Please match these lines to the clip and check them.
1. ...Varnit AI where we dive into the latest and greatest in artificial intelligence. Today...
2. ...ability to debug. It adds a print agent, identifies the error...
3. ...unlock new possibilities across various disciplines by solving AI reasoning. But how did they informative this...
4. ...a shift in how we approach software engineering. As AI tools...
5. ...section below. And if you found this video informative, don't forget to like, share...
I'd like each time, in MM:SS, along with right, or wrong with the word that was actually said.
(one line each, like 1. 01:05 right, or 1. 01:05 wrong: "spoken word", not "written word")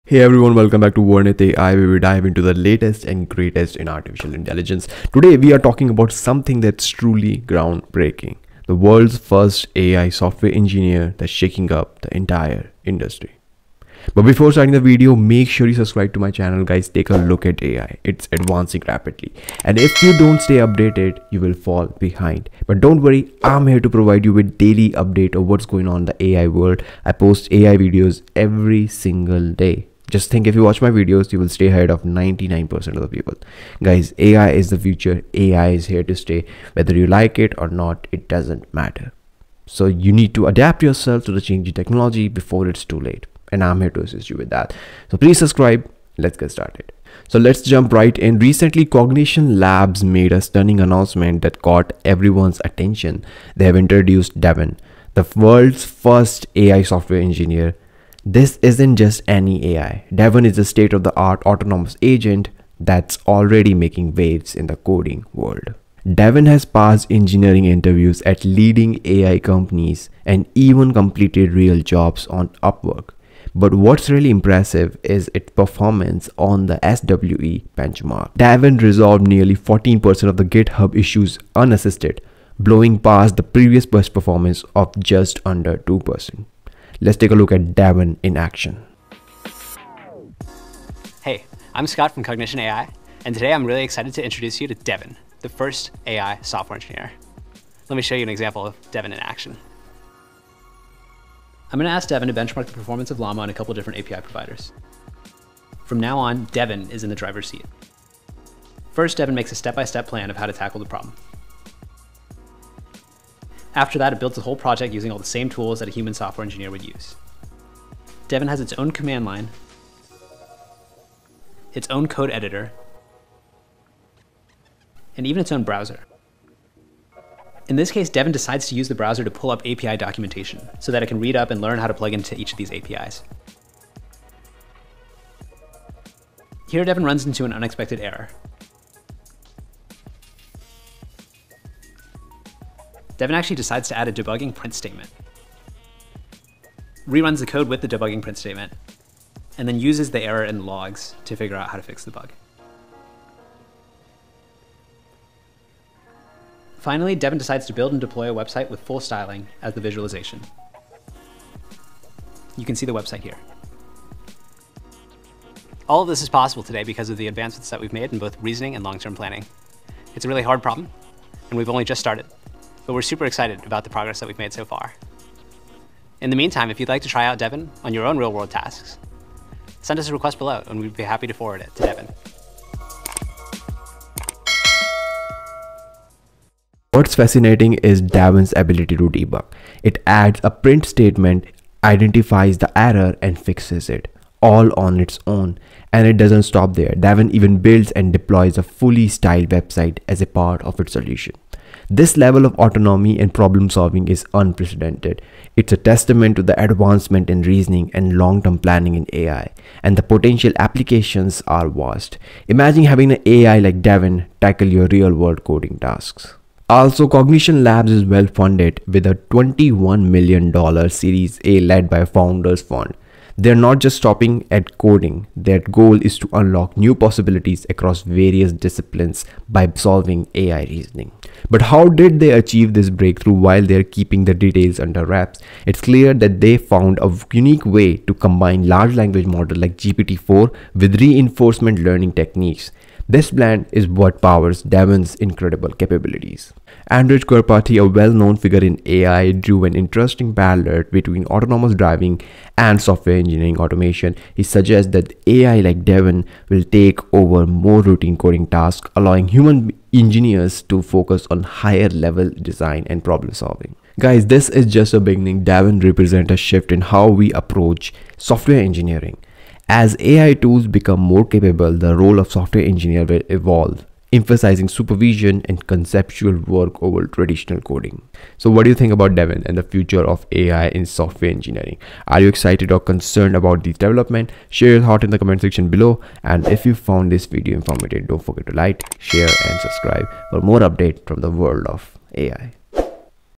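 1. 00:01 right
2. 03:08 wrong: "statement", not "agent"
3. 03:46 wrong: "achieve", not "informative"
4. 04:26 right
5. 04:45 right.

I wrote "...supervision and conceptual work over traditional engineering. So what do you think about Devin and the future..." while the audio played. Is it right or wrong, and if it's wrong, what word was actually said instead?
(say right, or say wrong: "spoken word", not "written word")
wrong: "coding", not "engineering".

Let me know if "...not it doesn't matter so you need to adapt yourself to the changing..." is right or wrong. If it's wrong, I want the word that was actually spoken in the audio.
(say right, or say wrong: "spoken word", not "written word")
right.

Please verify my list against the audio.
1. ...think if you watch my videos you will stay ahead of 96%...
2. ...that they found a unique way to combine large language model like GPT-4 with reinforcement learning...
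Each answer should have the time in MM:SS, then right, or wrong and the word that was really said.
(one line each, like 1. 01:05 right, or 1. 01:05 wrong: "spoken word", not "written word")
1. 00:30 wrong: "99", not "96"
2. 03:56 right.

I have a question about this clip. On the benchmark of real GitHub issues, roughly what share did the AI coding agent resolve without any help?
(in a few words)
14%.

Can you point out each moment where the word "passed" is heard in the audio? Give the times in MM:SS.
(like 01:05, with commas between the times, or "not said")
01:06.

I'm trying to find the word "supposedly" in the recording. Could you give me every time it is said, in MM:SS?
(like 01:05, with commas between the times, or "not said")
not said.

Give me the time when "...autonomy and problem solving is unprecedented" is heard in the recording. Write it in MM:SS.
03:22.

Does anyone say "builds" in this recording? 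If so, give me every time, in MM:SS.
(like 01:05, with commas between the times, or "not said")
01:54, 02:37, 03:17.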